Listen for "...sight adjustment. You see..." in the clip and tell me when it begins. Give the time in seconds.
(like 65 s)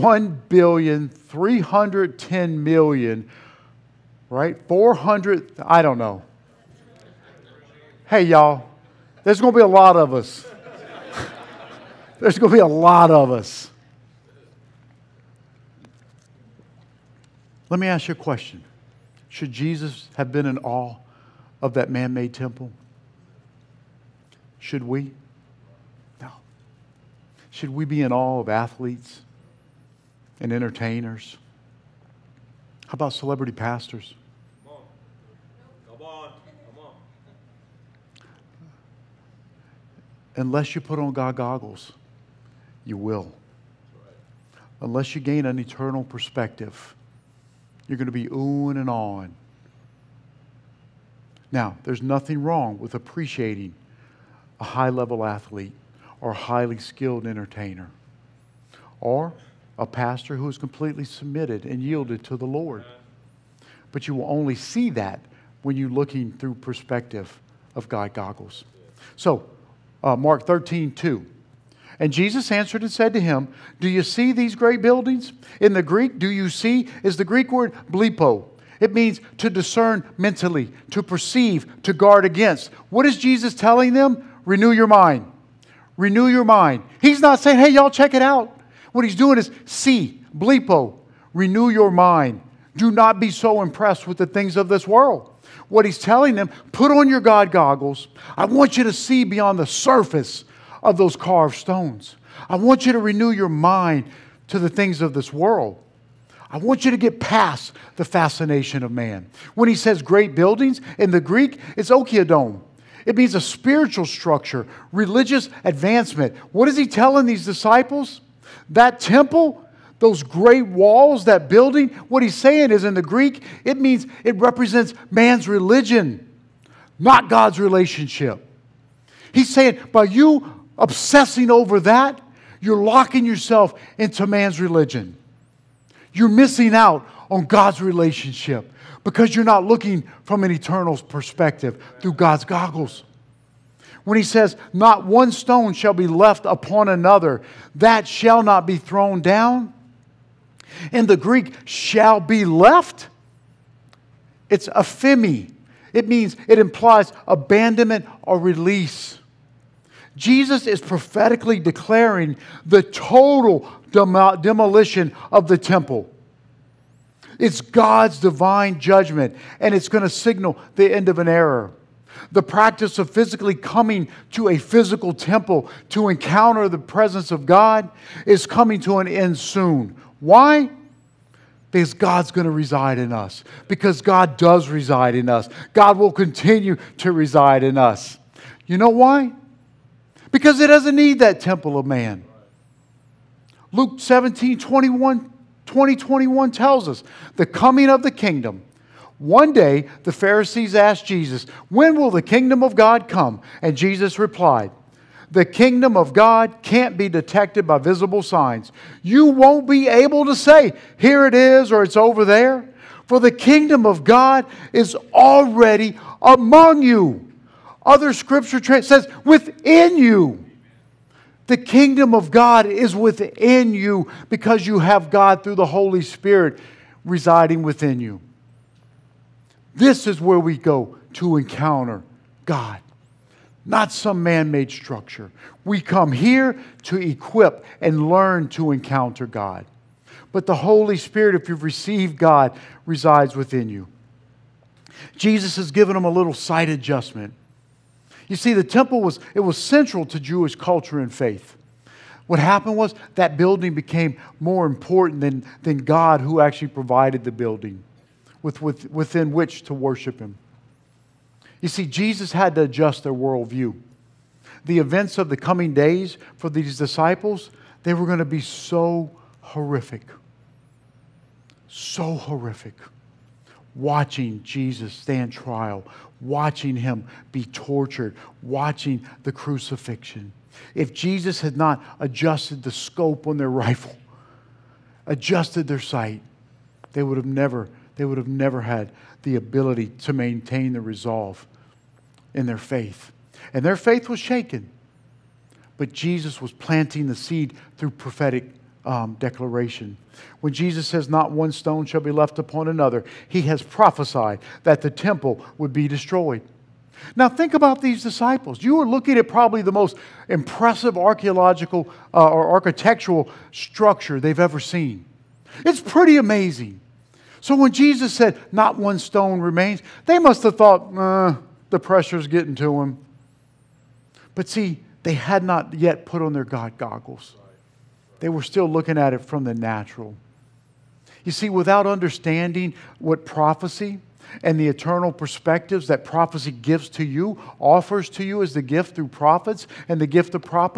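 246 s.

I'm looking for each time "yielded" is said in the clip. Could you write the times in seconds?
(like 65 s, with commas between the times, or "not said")
61 s.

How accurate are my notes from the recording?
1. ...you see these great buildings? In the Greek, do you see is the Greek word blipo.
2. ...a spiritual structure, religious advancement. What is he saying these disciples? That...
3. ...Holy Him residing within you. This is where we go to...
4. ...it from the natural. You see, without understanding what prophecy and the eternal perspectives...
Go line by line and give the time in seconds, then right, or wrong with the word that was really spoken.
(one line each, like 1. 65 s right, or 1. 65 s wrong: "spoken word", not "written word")
1. 73 s right
2. 113 s wrong: "telling", not "saying"
3. 225 s wrong: "Spirit", not "Him"
4. 329 s right.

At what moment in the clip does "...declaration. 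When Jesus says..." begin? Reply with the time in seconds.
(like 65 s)
299 s.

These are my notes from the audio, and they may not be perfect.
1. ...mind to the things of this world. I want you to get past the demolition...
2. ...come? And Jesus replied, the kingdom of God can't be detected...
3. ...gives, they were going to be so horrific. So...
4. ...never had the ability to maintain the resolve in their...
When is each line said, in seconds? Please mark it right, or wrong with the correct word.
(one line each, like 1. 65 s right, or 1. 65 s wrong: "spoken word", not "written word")
1. 103 s wrong: "fascination", not "demolition"
2. 203 s right
3. 266 s wrong: "disciples", not "gives"
4. 288 s right.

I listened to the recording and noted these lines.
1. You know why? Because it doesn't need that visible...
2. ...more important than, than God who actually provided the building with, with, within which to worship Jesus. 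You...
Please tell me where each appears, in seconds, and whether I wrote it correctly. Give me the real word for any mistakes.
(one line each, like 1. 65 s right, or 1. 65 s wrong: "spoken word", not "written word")
1. 188 s wrong: "temple", not "visible"
2. 254 s wrong: "Him", not "Jesus".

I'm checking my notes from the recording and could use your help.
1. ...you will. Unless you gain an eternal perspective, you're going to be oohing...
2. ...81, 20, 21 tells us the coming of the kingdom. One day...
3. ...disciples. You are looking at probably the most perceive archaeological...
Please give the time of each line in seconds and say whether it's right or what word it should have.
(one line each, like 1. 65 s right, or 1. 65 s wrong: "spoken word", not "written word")
1. 42 s right
2. 194 s wrong: "21", not "81"
3. 308 s wrong: "impressive", not "perceive".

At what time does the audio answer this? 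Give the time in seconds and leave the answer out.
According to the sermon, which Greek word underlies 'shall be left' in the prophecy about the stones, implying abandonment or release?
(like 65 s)
154 s.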